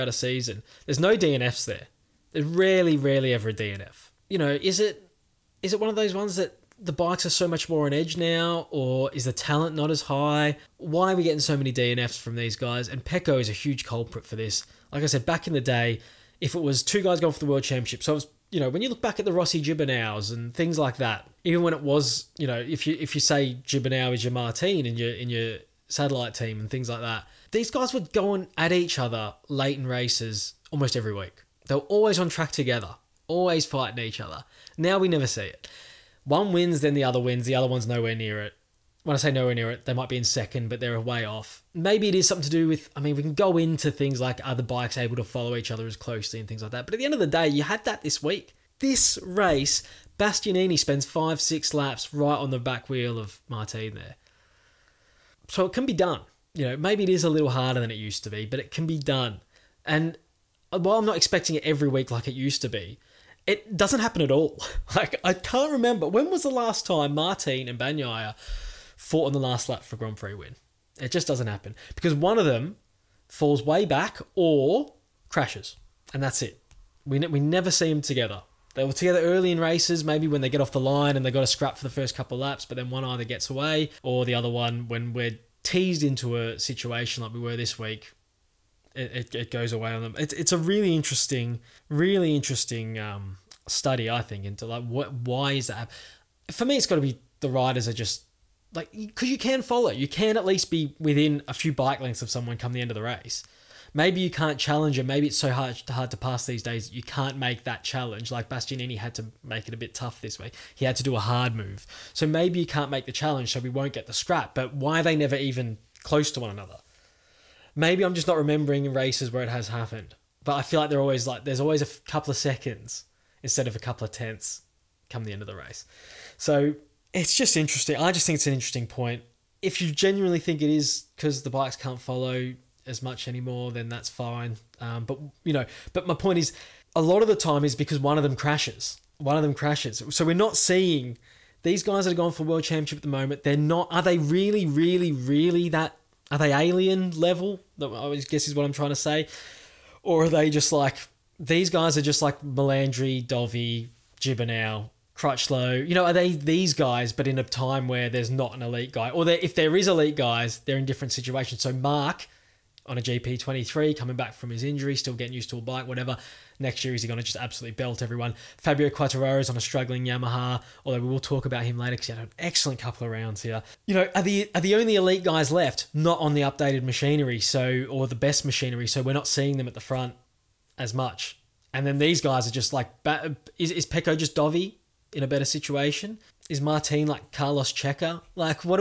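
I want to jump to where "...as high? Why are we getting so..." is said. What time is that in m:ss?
0:09.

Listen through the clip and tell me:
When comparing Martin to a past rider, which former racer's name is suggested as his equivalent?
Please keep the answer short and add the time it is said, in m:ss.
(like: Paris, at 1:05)
Carlos Checa, at 3:07.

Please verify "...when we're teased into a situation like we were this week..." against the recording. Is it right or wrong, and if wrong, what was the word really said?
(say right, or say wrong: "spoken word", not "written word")
right.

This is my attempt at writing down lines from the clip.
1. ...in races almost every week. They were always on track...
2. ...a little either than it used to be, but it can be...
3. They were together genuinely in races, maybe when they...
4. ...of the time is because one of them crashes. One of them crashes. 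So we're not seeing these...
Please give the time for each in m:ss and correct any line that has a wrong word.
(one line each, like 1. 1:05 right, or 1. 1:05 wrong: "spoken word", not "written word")
1. 0:29 right
2. 0:57 wrong: "harder", not "either"
3. 1:18 wrong: "early", not "genuinely"
4. 2:17 right.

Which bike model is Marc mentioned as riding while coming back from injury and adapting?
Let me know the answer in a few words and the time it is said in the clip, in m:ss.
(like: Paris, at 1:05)
GP23, at 2:43.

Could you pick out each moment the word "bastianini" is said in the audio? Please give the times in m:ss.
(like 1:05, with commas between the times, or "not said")
0:50, 1:48.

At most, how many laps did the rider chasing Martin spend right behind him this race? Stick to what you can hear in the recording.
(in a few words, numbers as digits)
6.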